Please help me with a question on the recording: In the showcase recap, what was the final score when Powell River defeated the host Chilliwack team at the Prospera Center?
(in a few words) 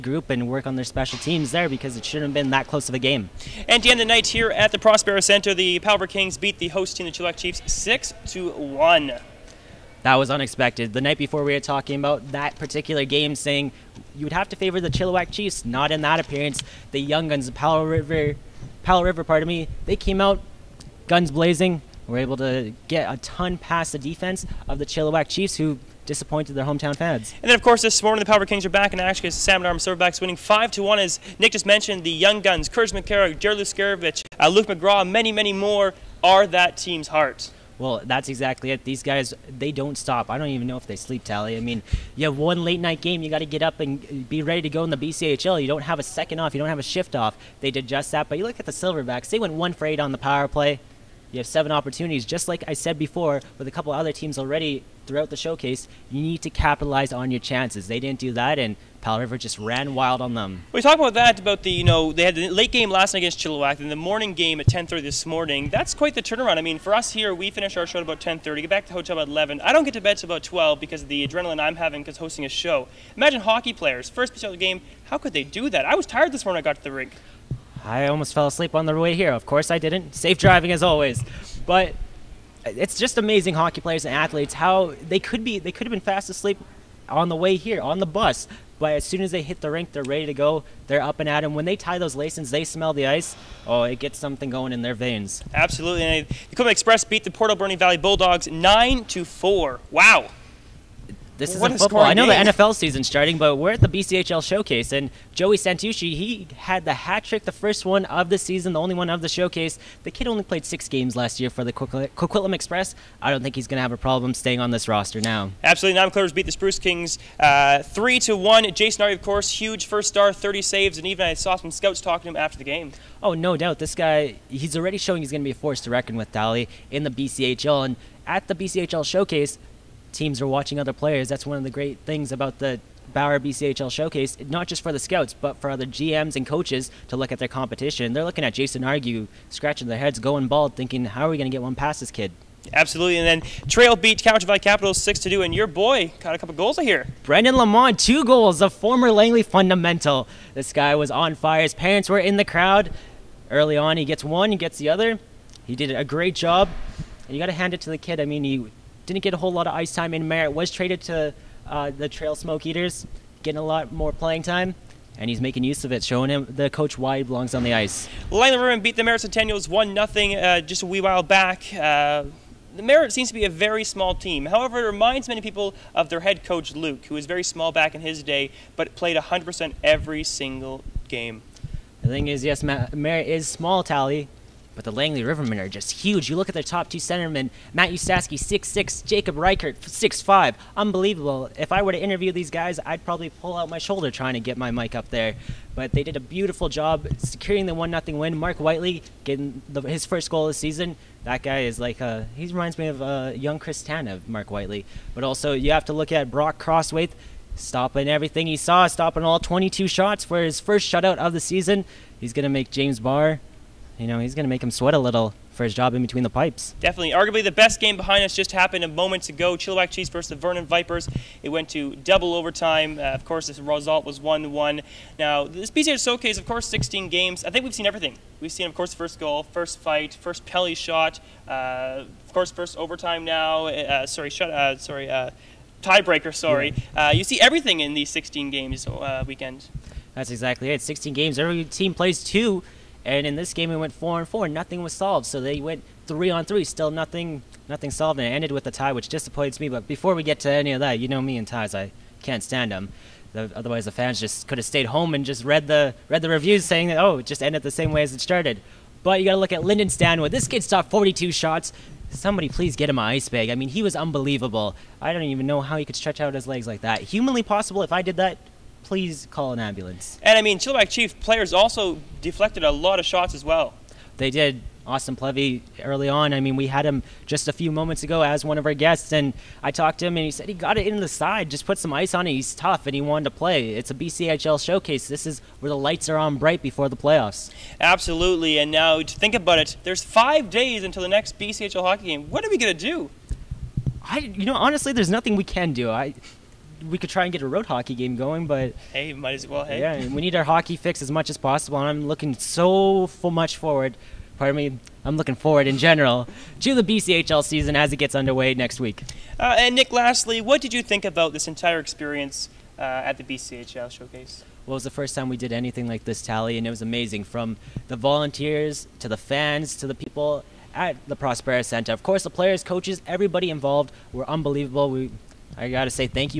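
6 to 1.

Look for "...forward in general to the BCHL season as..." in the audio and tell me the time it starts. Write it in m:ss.
5:05.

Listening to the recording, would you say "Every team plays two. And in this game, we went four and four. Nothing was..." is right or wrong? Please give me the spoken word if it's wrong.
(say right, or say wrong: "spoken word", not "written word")
right.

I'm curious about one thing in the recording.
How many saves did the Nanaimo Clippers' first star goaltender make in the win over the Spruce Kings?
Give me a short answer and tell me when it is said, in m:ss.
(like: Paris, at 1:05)
30, at 2:00.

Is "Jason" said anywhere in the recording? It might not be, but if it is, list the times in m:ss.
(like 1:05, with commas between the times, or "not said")
1:58, 2:18.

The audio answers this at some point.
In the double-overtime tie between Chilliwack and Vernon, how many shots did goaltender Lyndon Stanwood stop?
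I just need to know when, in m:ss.
4:20.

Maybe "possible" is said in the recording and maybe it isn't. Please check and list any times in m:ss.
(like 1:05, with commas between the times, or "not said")
4:27, 5:01.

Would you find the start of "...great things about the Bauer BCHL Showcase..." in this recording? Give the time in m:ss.
2:11.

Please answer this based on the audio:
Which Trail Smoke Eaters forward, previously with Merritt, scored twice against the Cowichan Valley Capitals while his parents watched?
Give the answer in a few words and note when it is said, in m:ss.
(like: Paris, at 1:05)
Brendan Lamont, at 2:27.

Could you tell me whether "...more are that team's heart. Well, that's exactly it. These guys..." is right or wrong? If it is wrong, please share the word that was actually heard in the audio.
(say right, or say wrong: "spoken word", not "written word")
right.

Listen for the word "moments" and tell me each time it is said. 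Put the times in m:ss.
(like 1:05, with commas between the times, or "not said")
3:38, 4:37.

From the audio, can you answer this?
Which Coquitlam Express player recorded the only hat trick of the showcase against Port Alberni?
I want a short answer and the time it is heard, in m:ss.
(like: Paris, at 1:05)
Joey Santucci, at 1:45.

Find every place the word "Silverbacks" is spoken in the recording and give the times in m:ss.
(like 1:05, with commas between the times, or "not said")
0:29, 0:48.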